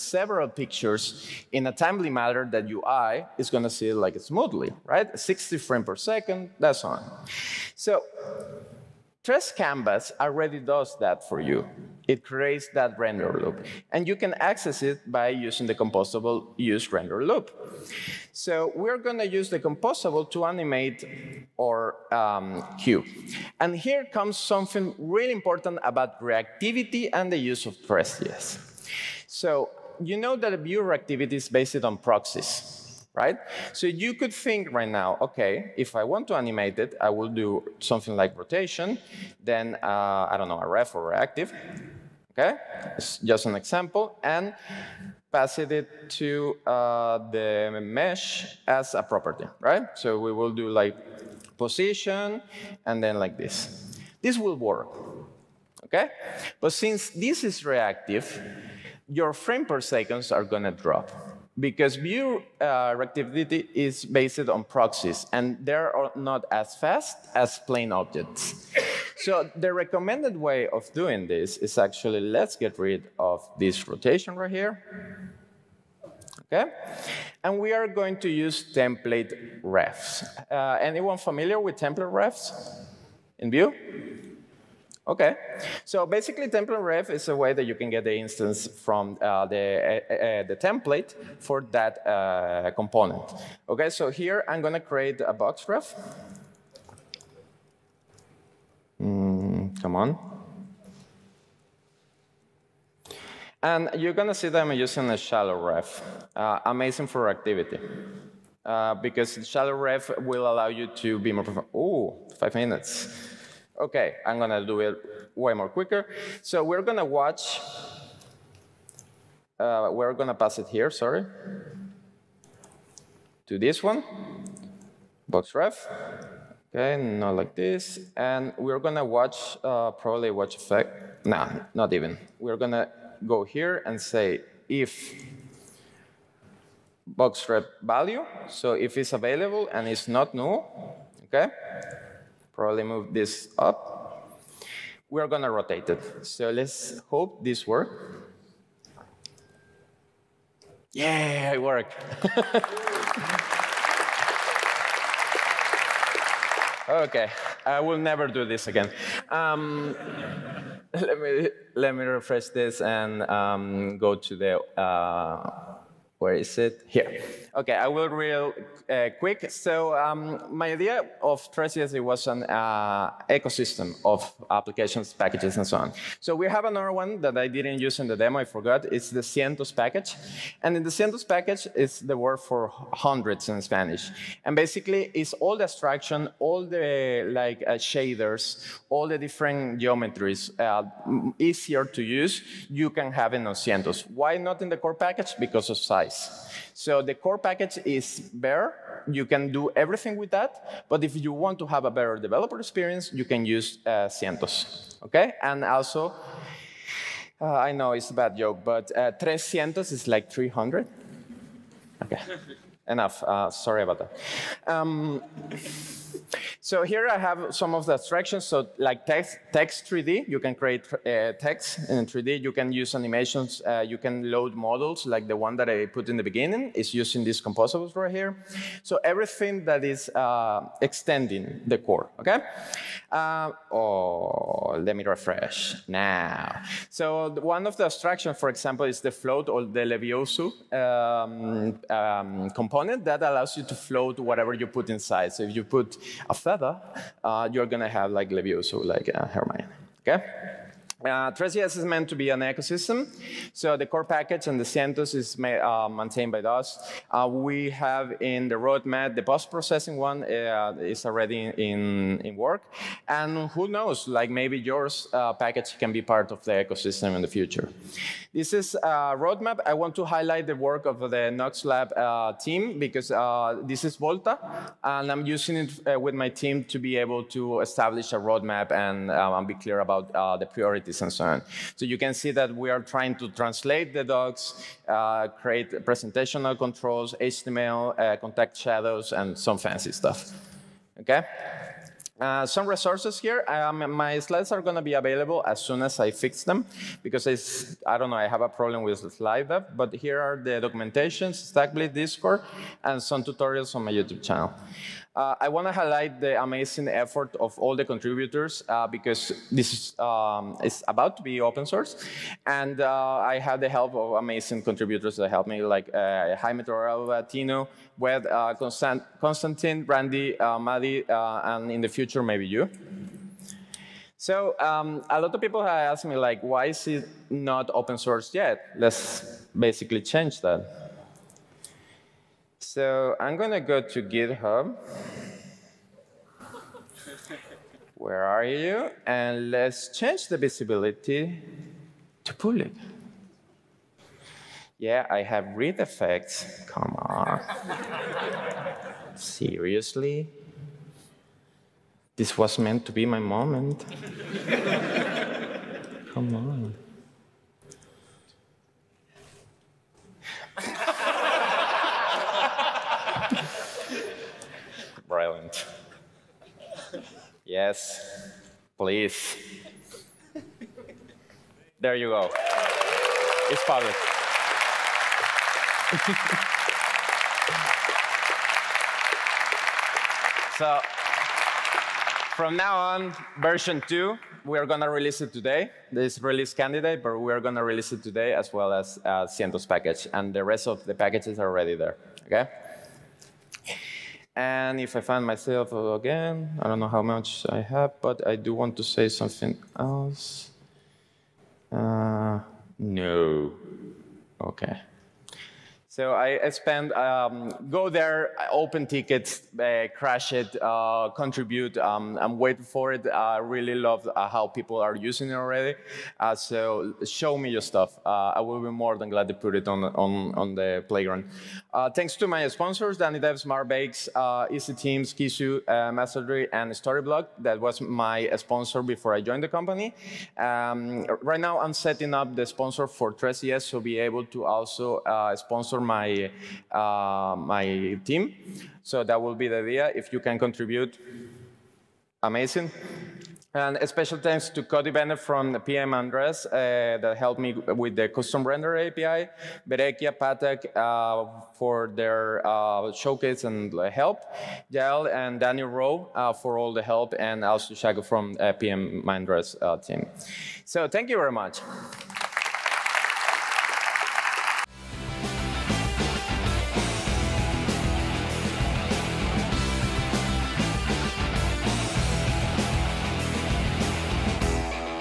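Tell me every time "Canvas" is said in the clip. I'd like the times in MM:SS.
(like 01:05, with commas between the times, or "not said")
00:09.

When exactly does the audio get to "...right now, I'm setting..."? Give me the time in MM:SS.
07:11.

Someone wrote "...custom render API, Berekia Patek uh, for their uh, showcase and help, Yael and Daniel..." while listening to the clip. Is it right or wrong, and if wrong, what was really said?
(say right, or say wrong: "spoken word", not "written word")
right.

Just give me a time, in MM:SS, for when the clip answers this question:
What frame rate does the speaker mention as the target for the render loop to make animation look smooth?
00:05.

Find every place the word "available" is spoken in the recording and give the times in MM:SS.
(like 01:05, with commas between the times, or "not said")
02:19, 04:54.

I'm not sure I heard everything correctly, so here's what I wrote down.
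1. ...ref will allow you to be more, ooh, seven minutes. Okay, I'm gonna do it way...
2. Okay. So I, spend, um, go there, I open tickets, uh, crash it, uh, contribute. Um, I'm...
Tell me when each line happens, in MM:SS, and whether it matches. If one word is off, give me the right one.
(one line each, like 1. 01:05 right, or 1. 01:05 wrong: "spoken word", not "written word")
1. 01:49 wrong: "five", not "seven"
2. 06:44 right.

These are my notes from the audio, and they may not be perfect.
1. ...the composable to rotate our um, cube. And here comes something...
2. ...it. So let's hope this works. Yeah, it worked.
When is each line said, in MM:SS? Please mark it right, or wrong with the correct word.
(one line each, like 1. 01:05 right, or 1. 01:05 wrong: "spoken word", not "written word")
1. 00:19 wrong: "animate", not "rotate"
2. 02:25 right.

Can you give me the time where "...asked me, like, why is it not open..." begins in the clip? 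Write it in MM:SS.
05:25.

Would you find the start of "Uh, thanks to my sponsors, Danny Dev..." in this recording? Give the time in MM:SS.
07:01.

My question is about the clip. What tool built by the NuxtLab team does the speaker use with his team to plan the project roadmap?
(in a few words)
Volta.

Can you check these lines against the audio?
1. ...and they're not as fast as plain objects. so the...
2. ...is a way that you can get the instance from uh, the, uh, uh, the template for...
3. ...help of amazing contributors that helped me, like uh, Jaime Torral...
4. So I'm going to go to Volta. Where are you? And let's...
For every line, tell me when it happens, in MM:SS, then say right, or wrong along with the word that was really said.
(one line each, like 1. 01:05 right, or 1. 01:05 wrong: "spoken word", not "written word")
1. 01:05 right
2. 01:27 right
3. 05:13 right
4. 05:32 wrong: "GitHub", not "Volta".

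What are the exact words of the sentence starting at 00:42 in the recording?
It's just an example, and pass it to uh, the mesh as a property, right?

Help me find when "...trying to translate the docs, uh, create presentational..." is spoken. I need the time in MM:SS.
04:42.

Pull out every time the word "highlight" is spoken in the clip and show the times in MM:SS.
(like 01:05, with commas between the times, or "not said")
04:30, 05:05.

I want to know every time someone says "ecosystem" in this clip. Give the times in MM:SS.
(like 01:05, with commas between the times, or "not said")
02:53, 04:12, 04:26.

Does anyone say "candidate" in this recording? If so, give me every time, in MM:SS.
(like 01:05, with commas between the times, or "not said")
06:26.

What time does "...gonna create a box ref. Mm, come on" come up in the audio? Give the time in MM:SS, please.
01:34.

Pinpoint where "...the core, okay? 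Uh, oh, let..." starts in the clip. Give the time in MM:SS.
03:51.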